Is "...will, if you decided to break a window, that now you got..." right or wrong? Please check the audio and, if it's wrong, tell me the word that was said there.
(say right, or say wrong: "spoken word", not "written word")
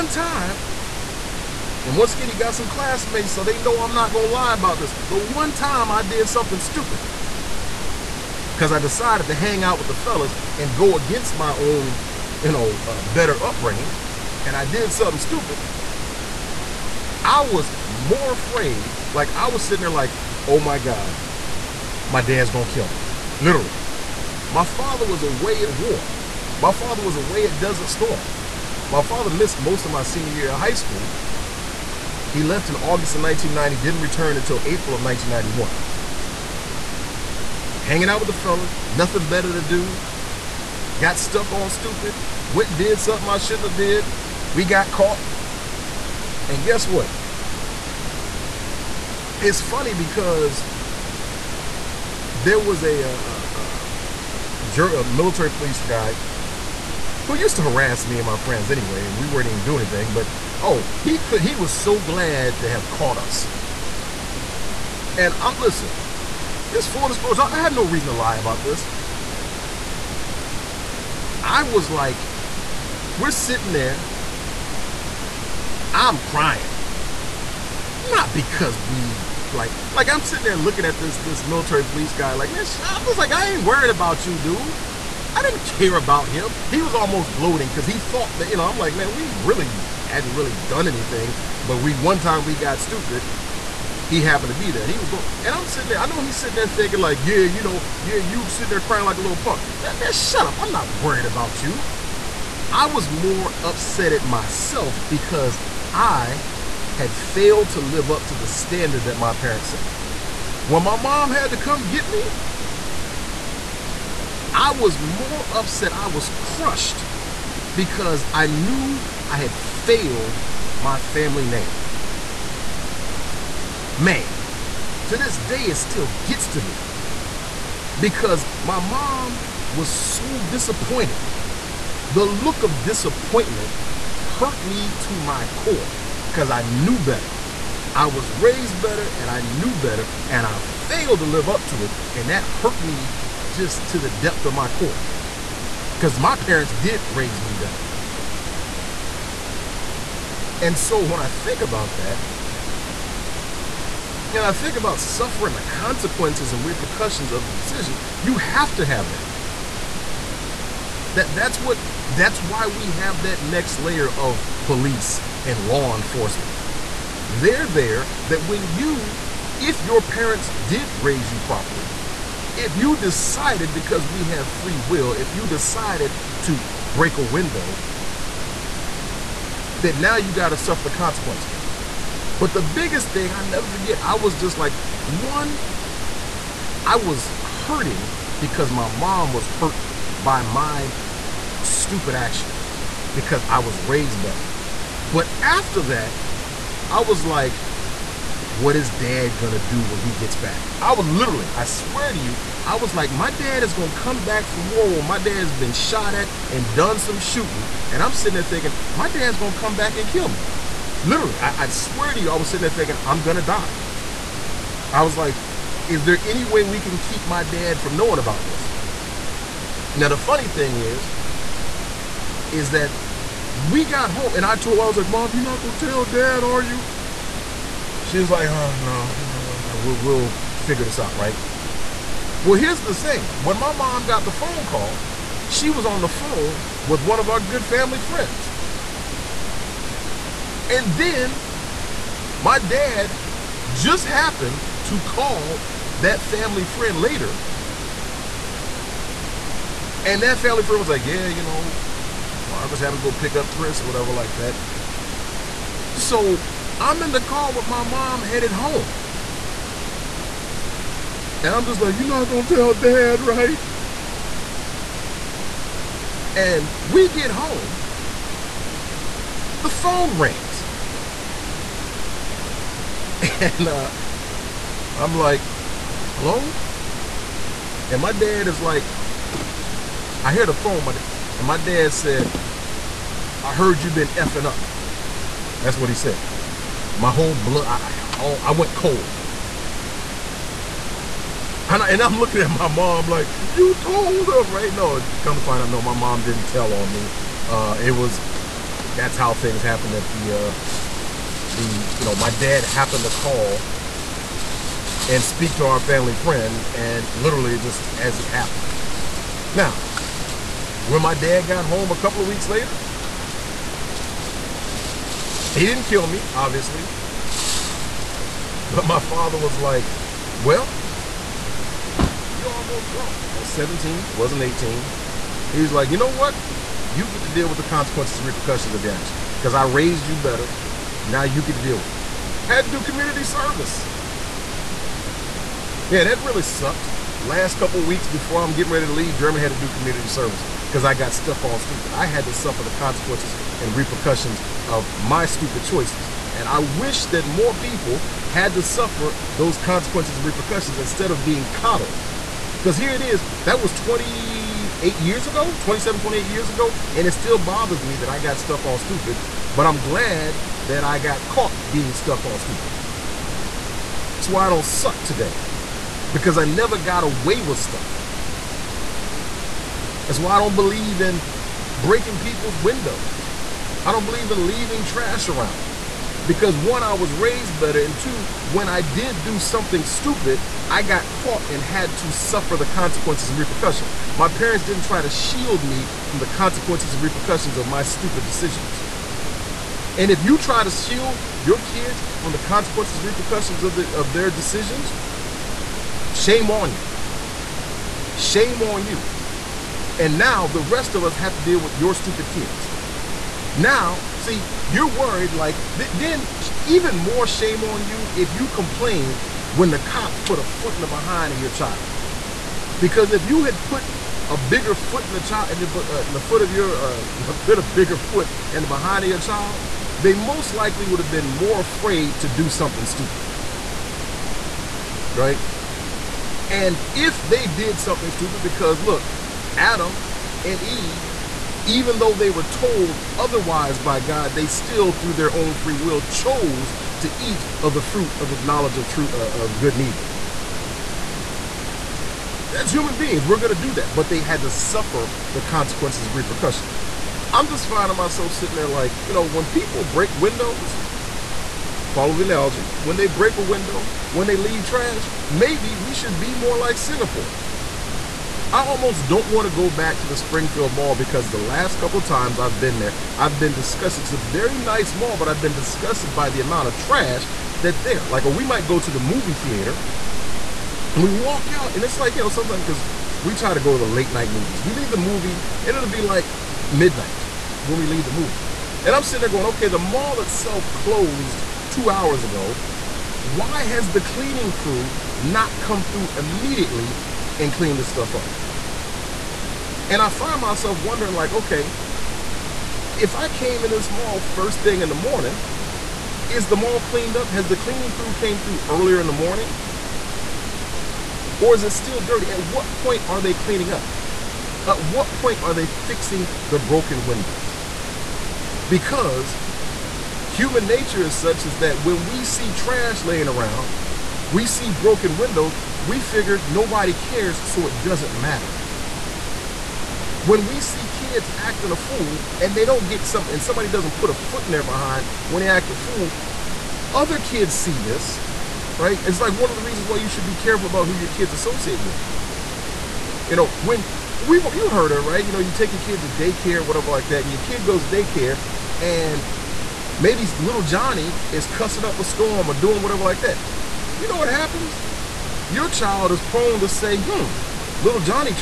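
right.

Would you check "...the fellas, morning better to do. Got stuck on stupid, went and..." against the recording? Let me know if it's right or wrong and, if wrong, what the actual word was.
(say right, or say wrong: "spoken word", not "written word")
wrong: "nothing", not "morning".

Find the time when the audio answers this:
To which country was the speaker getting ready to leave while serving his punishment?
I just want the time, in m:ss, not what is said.
5:39.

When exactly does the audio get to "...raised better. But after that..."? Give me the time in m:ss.
3:13.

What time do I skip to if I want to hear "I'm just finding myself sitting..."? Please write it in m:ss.
7:27.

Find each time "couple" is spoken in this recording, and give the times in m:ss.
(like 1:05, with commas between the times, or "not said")
5:11, 5:37, 7:41.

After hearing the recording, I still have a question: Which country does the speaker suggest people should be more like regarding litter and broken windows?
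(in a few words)
Singapore.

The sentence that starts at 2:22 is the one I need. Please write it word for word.
And that hurt me just to the depth of my core because my parents did raise me better.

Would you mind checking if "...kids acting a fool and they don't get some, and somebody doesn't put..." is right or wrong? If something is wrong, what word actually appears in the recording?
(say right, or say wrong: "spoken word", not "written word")
right.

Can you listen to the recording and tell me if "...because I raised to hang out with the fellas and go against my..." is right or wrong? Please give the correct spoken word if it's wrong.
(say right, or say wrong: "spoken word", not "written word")
wrong: "decided", not "raised".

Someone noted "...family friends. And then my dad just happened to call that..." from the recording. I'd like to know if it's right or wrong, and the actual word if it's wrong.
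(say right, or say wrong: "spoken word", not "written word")
right.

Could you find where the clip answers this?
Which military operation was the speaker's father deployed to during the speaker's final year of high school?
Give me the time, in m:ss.
0:27.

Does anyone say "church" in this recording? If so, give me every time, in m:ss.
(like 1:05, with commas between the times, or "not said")
not said.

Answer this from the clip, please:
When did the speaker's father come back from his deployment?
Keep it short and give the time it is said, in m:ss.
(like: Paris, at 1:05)
April 1991, at 0:34.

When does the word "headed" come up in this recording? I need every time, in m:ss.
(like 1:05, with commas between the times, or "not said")
4:18.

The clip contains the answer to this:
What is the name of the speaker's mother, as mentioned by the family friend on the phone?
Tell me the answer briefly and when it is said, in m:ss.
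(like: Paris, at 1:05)
Margaret, at 4:12.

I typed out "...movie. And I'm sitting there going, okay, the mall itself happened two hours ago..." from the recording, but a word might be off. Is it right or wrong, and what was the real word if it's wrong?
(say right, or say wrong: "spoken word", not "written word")
wrong: "closed", not "happened".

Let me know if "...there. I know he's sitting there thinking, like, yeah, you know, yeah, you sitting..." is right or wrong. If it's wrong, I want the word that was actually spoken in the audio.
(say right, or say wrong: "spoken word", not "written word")
right.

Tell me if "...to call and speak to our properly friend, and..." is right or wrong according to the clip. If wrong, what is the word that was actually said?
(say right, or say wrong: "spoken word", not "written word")
wrong: "family", not "properly".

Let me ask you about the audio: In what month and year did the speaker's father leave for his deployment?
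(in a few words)
August 1990.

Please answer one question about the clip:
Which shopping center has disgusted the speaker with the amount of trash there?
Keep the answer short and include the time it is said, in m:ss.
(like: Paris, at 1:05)
Springfield Mall, at 7:40.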